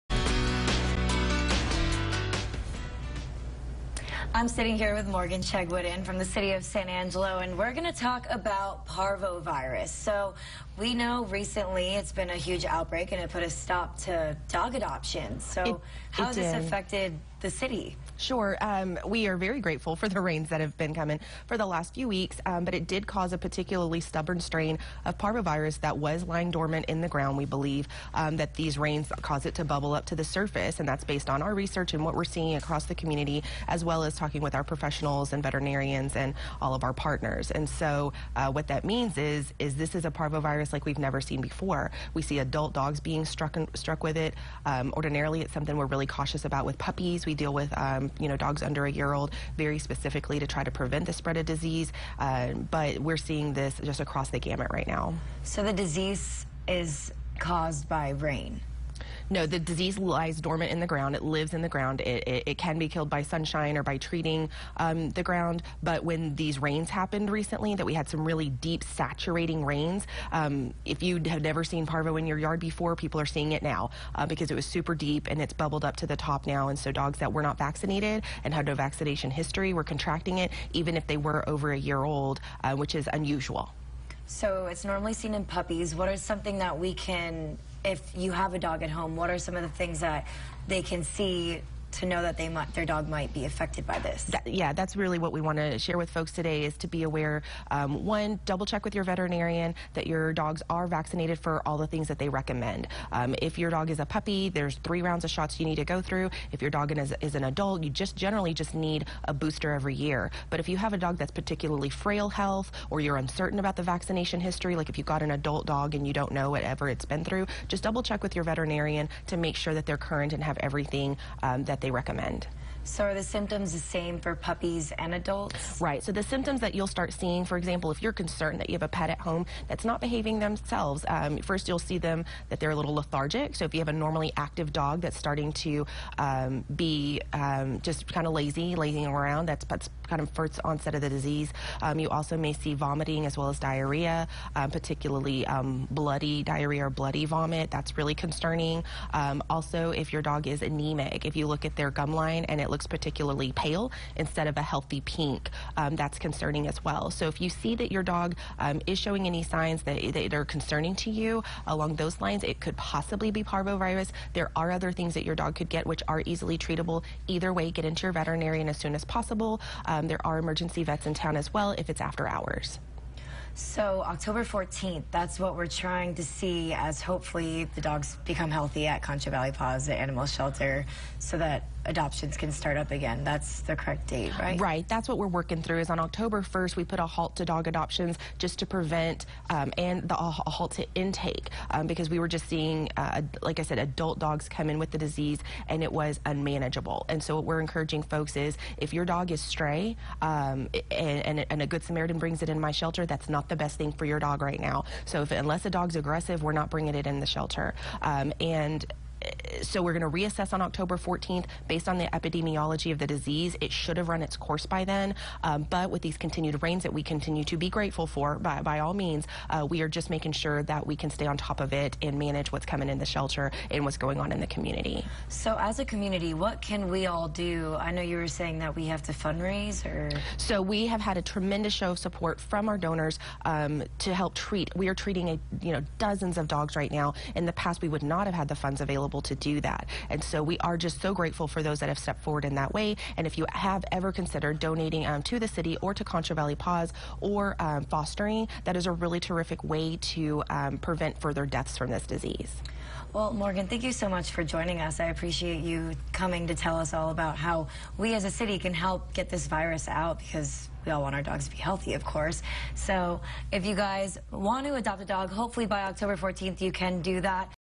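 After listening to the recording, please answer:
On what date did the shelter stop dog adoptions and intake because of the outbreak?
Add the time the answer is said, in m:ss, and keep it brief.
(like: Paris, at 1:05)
October 1, at 3:05.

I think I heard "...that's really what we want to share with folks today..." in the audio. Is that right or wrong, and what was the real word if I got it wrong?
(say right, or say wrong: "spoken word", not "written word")
right.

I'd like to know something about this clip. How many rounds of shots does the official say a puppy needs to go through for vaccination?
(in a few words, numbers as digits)
3.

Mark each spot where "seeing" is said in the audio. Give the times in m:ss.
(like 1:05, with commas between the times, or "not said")
0:32, 0:53, 1:13, 2:07, 3:12.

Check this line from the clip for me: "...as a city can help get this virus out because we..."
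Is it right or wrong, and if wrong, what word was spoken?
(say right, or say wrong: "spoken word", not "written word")
right.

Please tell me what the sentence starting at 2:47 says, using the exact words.
Either way, get into your veterinarian as soon as possible.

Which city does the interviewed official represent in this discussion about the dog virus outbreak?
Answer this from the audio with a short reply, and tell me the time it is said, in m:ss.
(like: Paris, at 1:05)
San Angelo, at 0:06.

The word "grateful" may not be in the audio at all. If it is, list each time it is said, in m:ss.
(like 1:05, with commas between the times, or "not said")
0:19, 3:37, 4:01.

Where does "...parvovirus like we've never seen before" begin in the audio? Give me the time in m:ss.
0:40.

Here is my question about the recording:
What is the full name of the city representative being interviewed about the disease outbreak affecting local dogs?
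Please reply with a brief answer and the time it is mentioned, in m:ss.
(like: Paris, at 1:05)
Morgan Chegwidden, at 0:05.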